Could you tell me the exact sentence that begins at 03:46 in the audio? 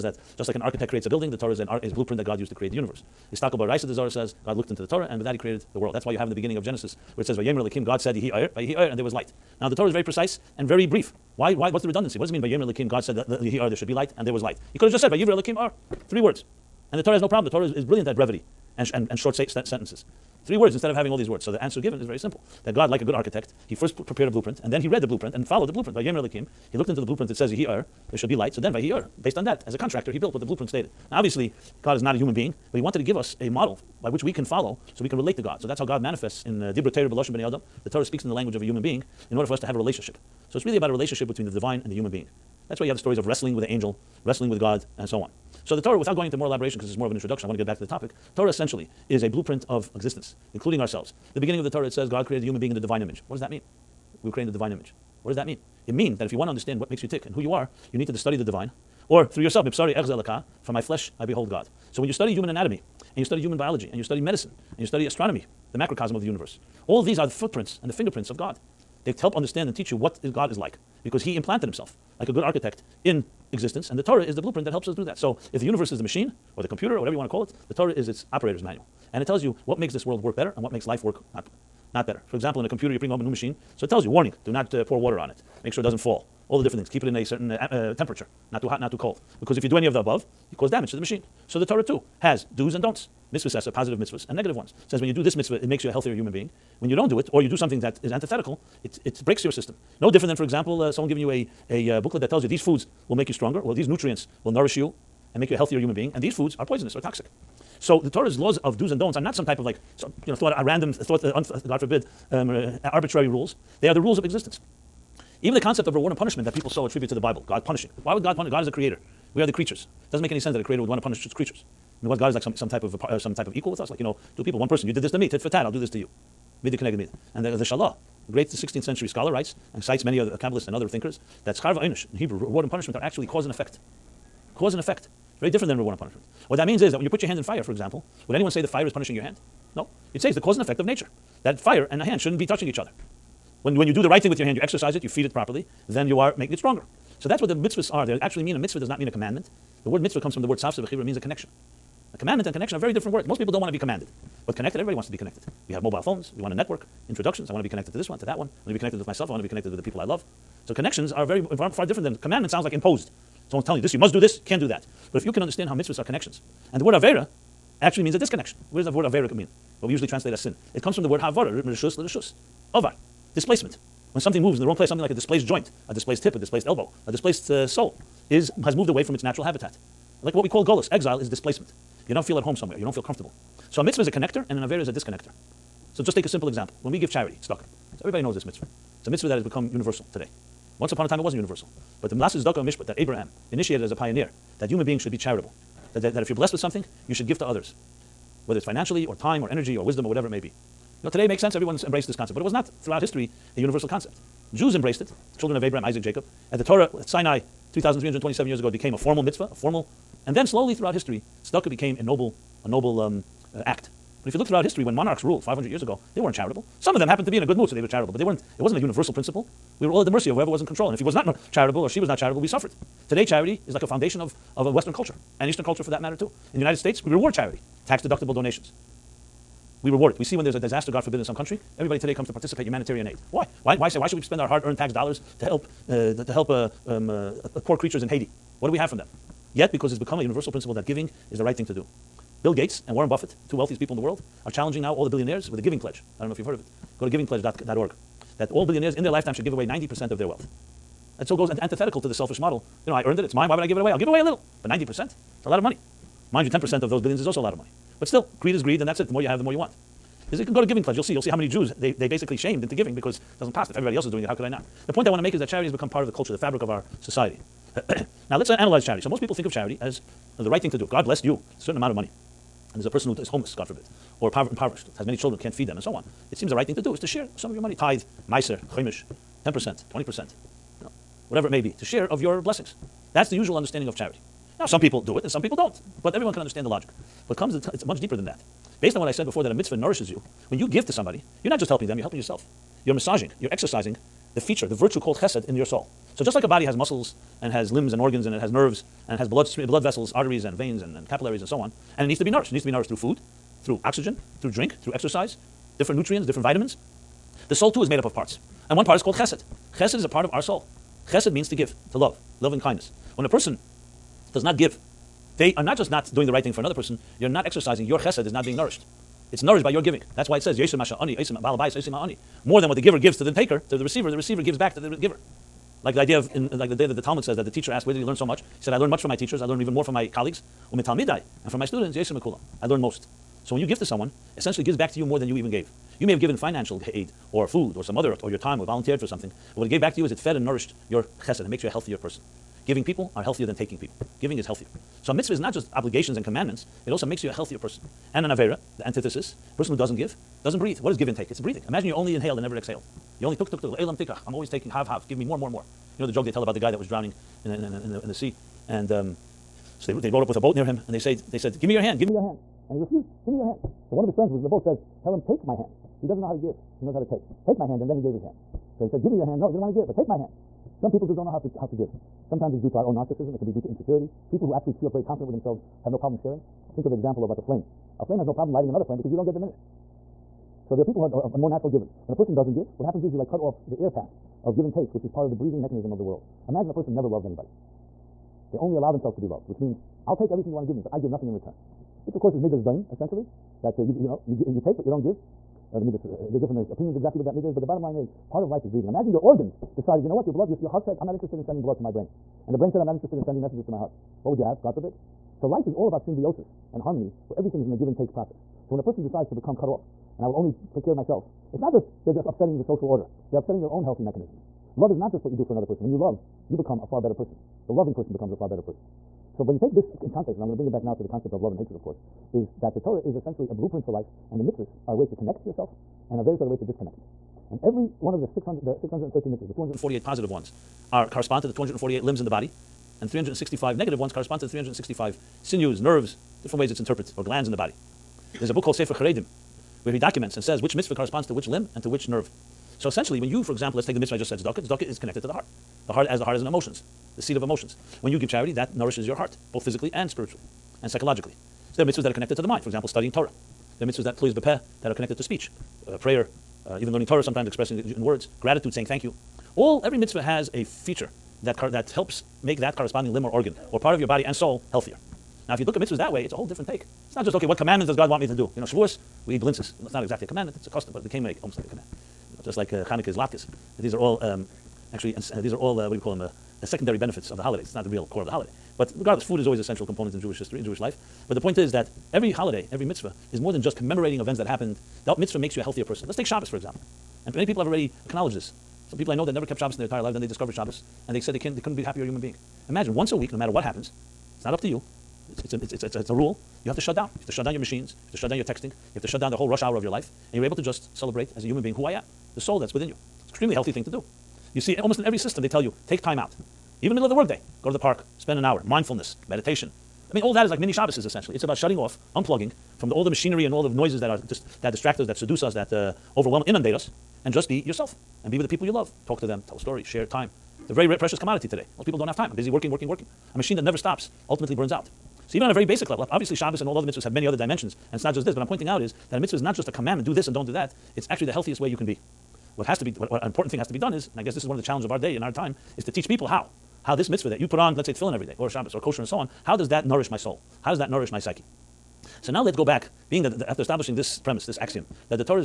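In the United States, we reward charity, tax deductible donations we reward it.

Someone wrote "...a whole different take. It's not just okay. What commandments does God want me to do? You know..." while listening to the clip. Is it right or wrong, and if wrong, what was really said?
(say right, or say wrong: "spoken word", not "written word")
right.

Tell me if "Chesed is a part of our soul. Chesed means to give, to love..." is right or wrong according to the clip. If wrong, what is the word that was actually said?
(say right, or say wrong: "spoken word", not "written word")
right.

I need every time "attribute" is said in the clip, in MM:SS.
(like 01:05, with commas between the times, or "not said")
01:56.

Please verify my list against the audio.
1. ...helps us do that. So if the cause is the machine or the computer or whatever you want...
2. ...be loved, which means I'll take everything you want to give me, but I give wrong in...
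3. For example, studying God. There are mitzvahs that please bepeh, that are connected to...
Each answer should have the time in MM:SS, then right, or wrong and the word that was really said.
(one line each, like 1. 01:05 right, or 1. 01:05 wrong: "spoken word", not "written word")
1. 01:14 wrong: "universe", not "cause"
2. 06:29 wrong: "nothing", not "wrong"
3. 07:32 wrong: "Torah", not "God".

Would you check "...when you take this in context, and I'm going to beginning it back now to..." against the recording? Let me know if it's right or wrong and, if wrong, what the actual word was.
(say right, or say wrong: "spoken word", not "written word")
wrong: "bring", not "beginning".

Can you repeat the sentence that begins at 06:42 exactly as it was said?
And the brain said, I'm not interested in sending messages to my heart.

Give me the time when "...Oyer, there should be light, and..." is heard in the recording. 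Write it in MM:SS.
00:13.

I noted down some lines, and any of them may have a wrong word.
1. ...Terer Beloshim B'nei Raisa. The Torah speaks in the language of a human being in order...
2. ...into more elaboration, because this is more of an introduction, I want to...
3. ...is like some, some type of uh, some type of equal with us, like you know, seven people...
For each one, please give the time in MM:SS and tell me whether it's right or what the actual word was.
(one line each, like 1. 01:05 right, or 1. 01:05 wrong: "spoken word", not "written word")
1. 00:36 wrong: "Adam", not "Raisa"
2. 00:46 right
3. 02:02 wrong: "two", not "seven".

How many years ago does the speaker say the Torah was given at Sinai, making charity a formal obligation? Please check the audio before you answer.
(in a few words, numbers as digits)
3,327.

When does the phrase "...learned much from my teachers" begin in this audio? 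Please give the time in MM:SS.
05:28.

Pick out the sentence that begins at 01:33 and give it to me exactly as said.
Mitzvahs are positive mitzvahs and negative ones.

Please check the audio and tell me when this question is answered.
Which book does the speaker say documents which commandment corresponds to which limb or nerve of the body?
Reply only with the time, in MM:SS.
07:18.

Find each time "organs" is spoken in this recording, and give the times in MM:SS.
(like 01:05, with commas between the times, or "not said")
04:57, 06:39, 07:43.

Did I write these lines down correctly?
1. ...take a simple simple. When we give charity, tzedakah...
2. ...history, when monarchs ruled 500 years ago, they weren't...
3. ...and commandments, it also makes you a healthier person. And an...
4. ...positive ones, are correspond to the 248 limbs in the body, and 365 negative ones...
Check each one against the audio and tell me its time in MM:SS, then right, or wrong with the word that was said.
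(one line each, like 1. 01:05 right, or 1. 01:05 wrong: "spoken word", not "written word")
1. 03:06 wrong: "example", not "simple"
2. 03:34 right
3. 05:46 right
4. 07:10 right.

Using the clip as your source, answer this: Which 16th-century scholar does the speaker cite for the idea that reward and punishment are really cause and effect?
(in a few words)
The Shalah.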